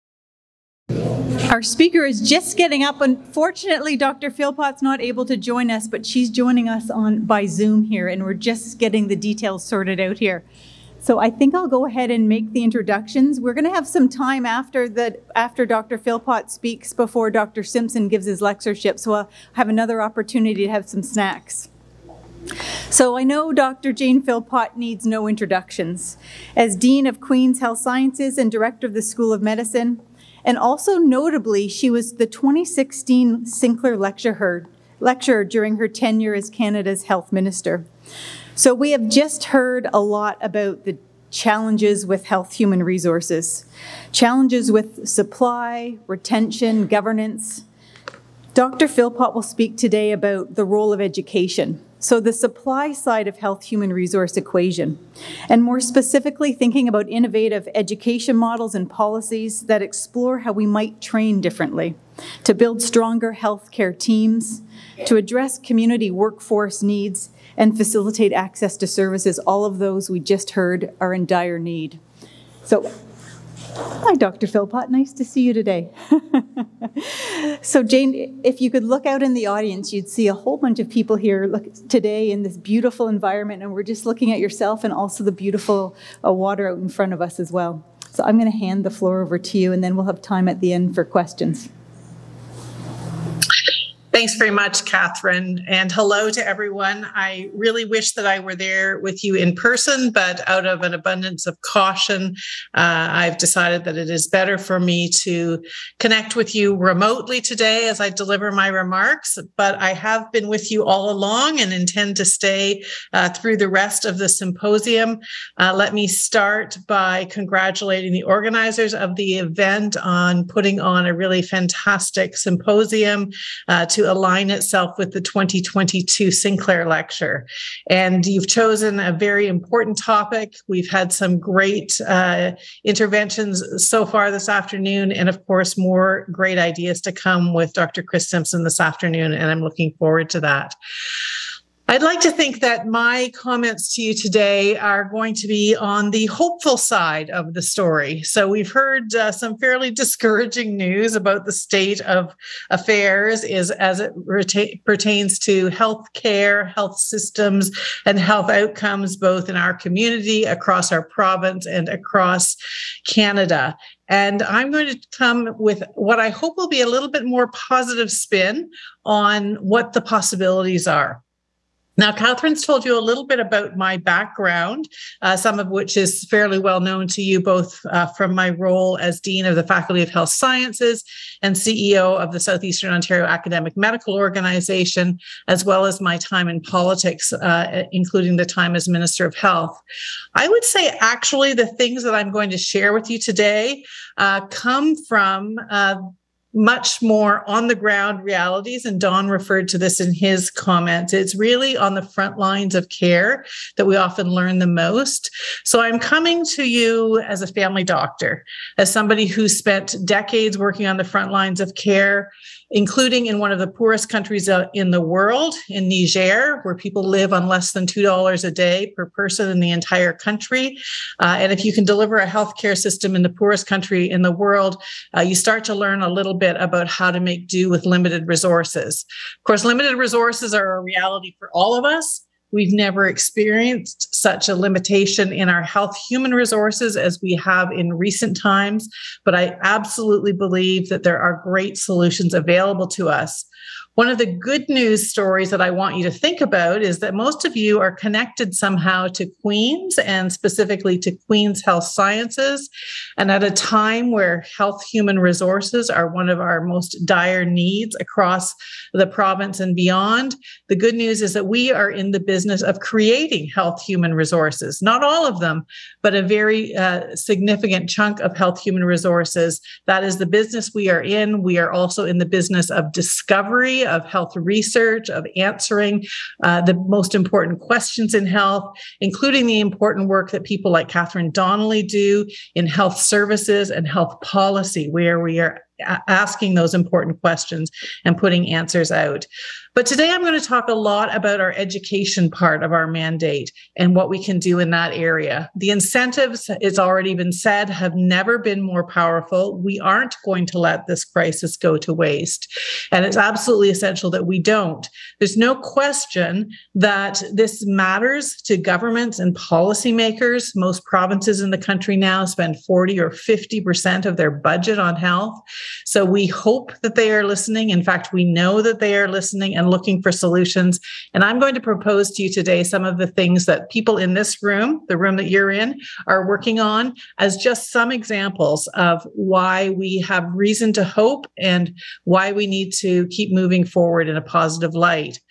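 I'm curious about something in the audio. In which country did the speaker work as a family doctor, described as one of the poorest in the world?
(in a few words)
Niger.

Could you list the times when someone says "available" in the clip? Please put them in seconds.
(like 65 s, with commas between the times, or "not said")
242 s.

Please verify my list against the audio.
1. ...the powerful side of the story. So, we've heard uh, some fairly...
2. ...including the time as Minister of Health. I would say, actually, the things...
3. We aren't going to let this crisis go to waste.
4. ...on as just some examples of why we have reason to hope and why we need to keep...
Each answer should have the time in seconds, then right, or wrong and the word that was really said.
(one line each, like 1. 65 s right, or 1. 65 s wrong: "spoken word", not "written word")
1. 146 s wrong: "hopeful", not "powerful"
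2. 187 s right
3. 299 s right
4. 326 s right.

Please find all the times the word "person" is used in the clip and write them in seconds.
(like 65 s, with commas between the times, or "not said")
99 s, 219 s.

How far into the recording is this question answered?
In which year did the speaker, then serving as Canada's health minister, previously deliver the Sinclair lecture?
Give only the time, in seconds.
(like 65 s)
32 s.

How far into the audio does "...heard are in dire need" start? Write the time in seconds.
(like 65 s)
70 s.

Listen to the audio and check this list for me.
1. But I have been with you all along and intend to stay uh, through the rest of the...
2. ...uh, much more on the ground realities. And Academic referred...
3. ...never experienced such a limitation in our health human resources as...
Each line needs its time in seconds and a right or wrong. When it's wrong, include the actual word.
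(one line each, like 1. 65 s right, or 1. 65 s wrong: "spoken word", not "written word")
1. 109 s right
2. 195 s wrong: "Don", not "Academic"
3. 232 s right.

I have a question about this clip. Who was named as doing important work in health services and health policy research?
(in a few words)
Catherine Donnelly.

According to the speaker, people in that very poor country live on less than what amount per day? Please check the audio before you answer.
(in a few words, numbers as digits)
$2.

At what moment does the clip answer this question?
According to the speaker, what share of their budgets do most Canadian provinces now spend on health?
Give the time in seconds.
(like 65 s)
312 s.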